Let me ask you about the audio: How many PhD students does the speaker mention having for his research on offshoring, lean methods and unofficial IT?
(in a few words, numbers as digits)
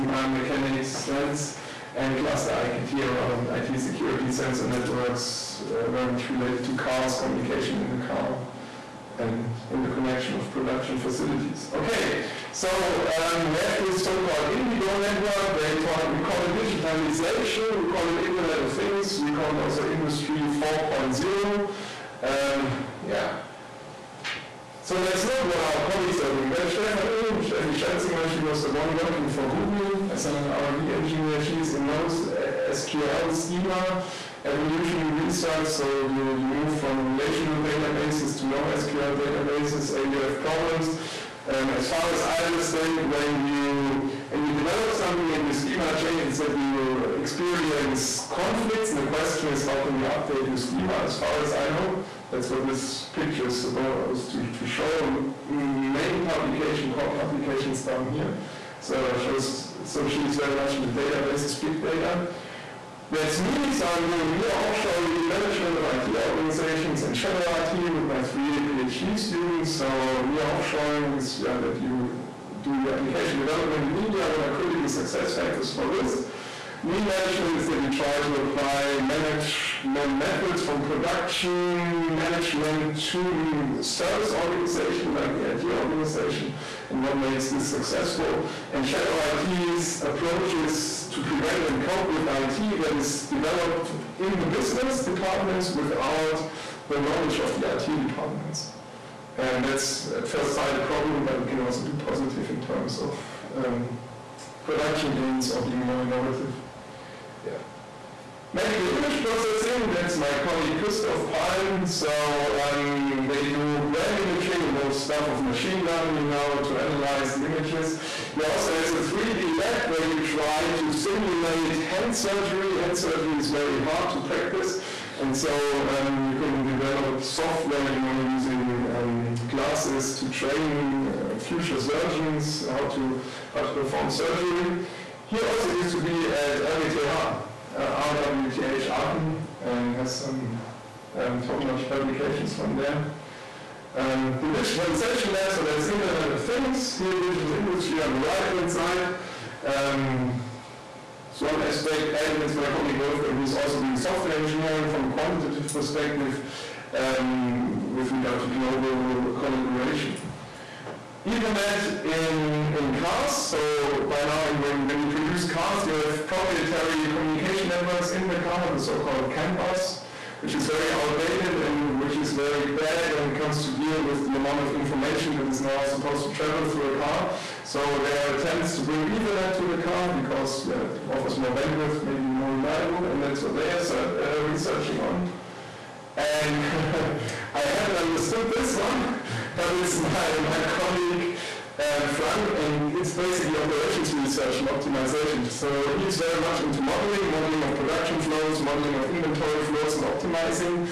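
3.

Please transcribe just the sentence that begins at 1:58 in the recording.
He also has a 3D lab where you try to simulate hand surgery.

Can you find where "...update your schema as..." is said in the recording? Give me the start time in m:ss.
0:50.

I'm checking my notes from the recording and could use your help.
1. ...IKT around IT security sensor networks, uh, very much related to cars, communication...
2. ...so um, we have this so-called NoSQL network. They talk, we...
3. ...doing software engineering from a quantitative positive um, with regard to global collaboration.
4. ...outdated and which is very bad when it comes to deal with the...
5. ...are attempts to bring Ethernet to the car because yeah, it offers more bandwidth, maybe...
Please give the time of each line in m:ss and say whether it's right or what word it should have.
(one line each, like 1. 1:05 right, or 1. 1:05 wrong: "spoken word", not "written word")
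1. 0:02 right
2. 0:12 wrong: "Indigo", not "NoSQL"
3. 2:33 wrong: "perspective", not "positive"
4. 2:50 right
5. 2:58 right.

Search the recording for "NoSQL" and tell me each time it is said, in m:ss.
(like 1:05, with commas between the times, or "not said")
0:31, 0:38.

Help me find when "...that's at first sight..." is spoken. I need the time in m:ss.
1:39.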